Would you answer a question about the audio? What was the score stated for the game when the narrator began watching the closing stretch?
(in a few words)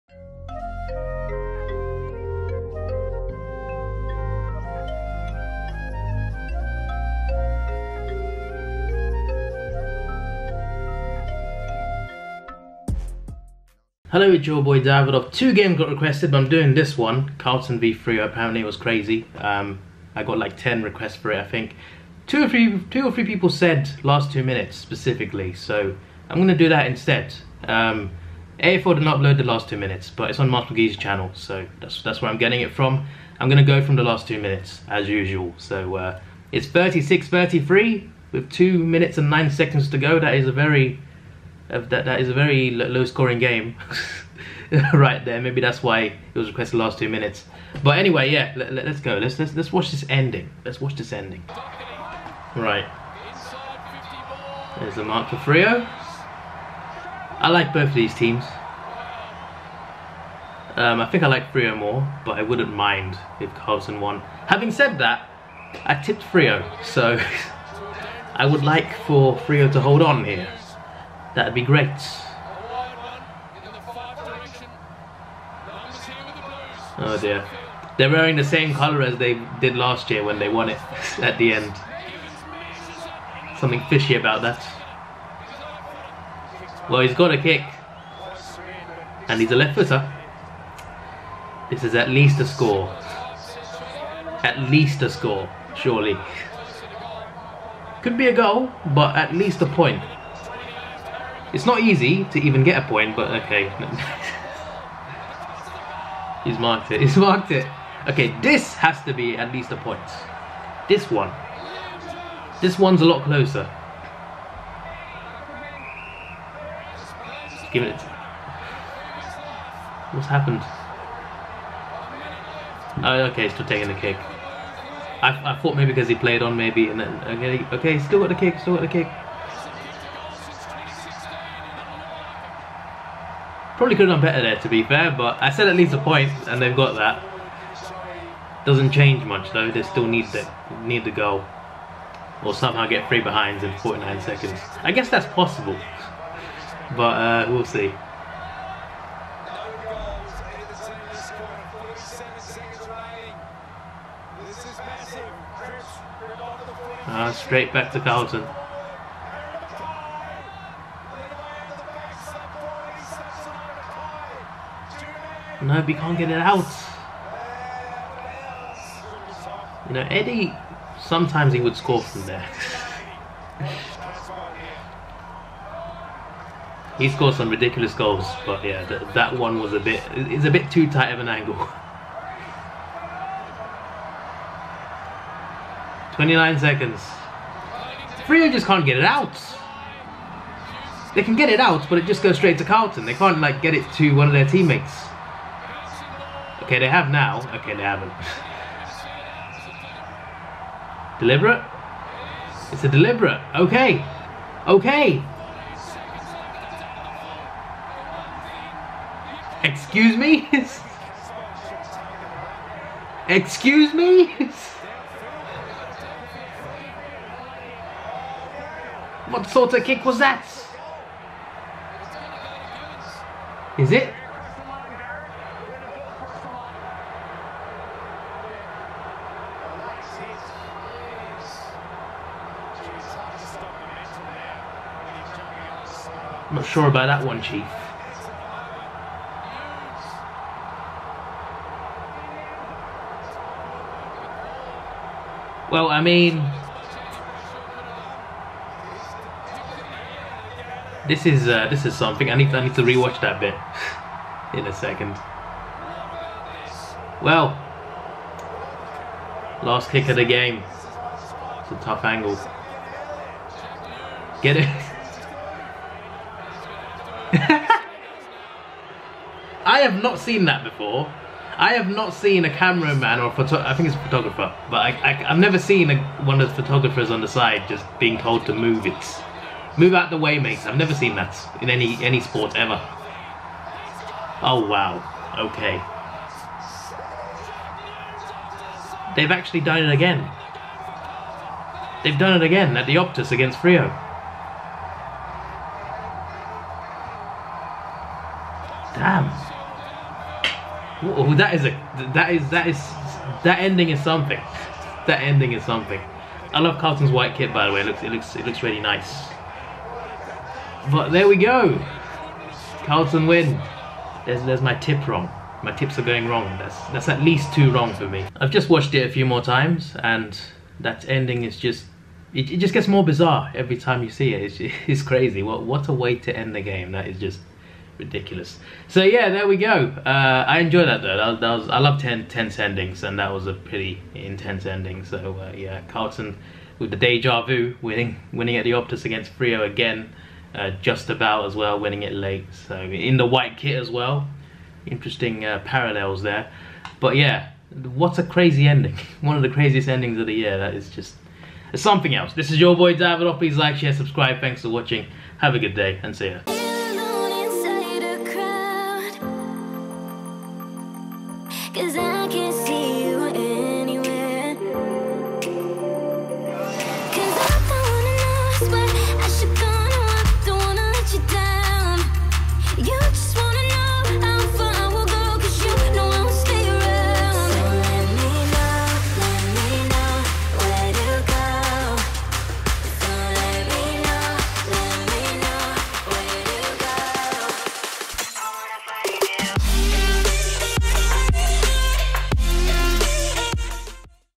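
36-33.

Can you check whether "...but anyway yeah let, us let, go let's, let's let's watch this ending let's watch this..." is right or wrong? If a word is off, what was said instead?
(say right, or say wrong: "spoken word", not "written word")
right.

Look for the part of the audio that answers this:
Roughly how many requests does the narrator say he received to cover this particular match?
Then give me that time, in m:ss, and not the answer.
0:20.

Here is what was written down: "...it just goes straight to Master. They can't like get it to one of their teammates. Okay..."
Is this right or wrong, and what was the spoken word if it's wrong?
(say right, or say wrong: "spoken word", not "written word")
wrong: "Carlton", not "Master".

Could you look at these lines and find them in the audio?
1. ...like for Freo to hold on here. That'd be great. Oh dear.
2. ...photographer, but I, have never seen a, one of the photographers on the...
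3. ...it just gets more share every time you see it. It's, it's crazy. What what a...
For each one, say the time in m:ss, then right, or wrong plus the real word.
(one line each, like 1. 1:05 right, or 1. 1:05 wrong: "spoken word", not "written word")
1. 1:08 right
2. 4:34 right
3. 5:22 wrong: "bizarre", not "share".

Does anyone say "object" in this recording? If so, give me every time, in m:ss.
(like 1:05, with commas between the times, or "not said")
not said.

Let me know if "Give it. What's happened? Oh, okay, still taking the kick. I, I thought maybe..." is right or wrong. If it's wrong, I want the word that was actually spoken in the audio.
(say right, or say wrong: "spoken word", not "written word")
right.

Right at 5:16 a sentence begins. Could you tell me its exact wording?
That's that's at least two wrong for me.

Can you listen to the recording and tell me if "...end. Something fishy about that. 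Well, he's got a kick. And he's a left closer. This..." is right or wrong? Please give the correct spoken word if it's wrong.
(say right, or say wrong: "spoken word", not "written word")
wrong: "footer", not "closer".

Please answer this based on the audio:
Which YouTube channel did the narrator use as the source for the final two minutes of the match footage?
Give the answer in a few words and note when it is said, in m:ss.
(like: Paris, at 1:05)
Master McGee, at 0:30.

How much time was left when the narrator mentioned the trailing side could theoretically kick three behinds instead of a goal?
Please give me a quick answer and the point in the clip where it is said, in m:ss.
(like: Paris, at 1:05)
49 seconds, at 2:23.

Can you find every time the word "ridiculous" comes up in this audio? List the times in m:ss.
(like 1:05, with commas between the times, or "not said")
2:57, 5:28.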